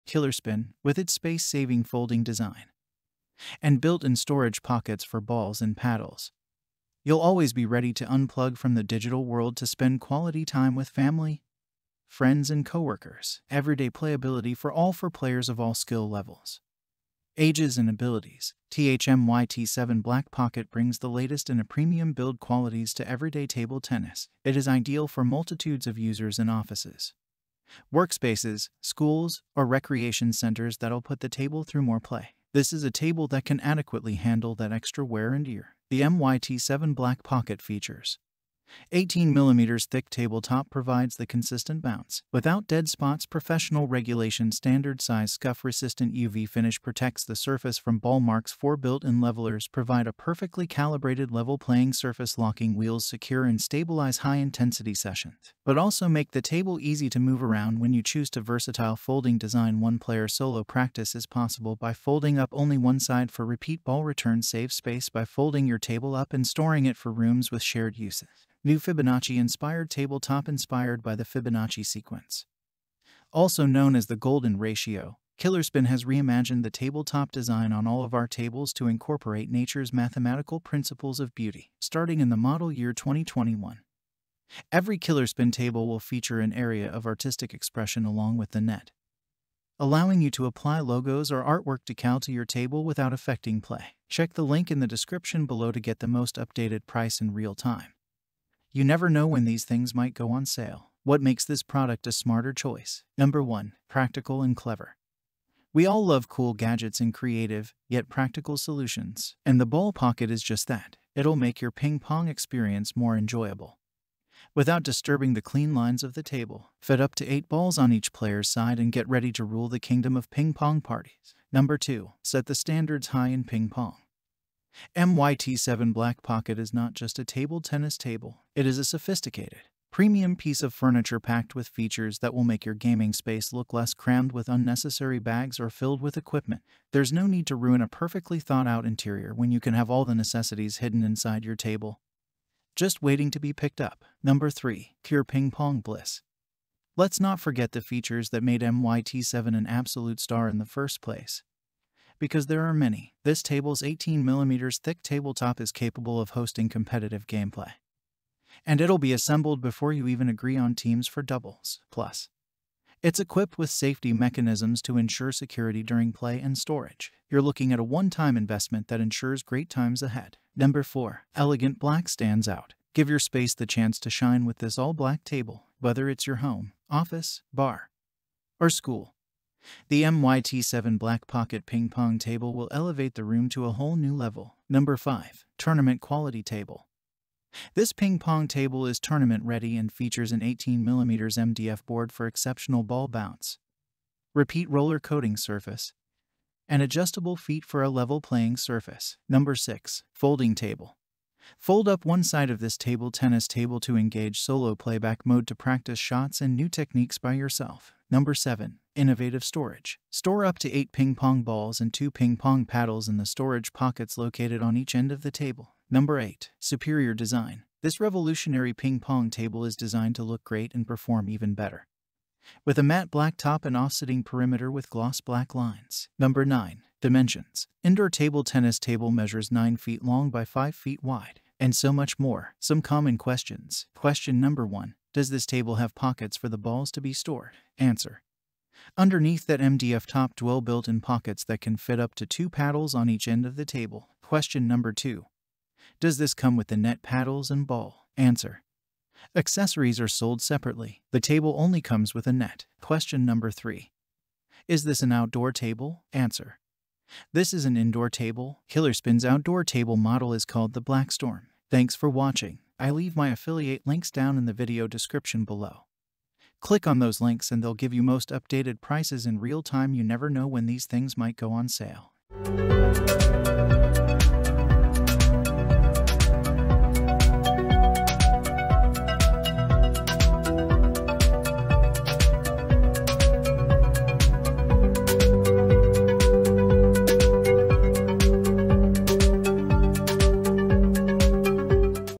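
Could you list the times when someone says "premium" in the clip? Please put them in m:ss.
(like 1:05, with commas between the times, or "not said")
0:21, 2:09.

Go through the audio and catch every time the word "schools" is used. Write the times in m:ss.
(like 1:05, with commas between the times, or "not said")
0:28, 2:58.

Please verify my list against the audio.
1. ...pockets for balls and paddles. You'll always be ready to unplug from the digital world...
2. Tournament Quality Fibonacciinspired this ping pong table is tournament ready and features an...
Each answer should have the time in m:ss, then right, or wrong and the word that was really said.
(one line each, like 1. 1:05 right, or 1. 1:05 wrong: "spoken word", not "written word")
1. 0:04 right
2. 3:05 wrong: "Table", not "Fibonacciinspired".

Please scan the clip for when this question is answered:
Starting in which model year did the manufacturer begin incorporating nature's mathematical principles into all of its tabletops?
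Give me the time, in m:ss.
1:22.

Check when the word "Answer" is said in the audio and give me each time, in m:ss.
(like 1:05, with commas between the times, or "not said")
3:57, 4:08, 4:16.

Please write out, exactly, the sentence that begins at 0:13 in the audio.
Everyday playability for all for players of all skill levels.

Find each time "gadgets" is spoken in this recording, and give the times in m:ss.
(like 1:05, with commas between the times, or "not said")
1:46.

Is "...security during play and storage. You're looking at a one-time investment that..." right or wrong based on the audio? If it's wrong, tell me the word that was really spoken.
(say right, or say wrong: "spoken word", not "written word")
right.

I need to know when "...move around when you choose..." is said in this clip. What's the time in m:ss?
0:57.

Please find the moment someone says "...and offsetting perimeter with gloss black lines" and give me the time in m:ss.
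3:43.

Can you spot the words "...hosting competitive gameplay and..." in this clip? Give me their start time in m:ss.
2:36.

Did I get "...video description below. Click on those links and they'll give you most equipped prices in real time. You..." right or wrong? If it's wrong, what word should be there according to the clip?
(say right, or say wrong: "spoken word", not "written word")
wrong: "updated", not "equipped".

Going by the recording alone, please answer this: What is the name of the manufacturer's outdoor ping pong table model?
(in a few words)
Blackstorm.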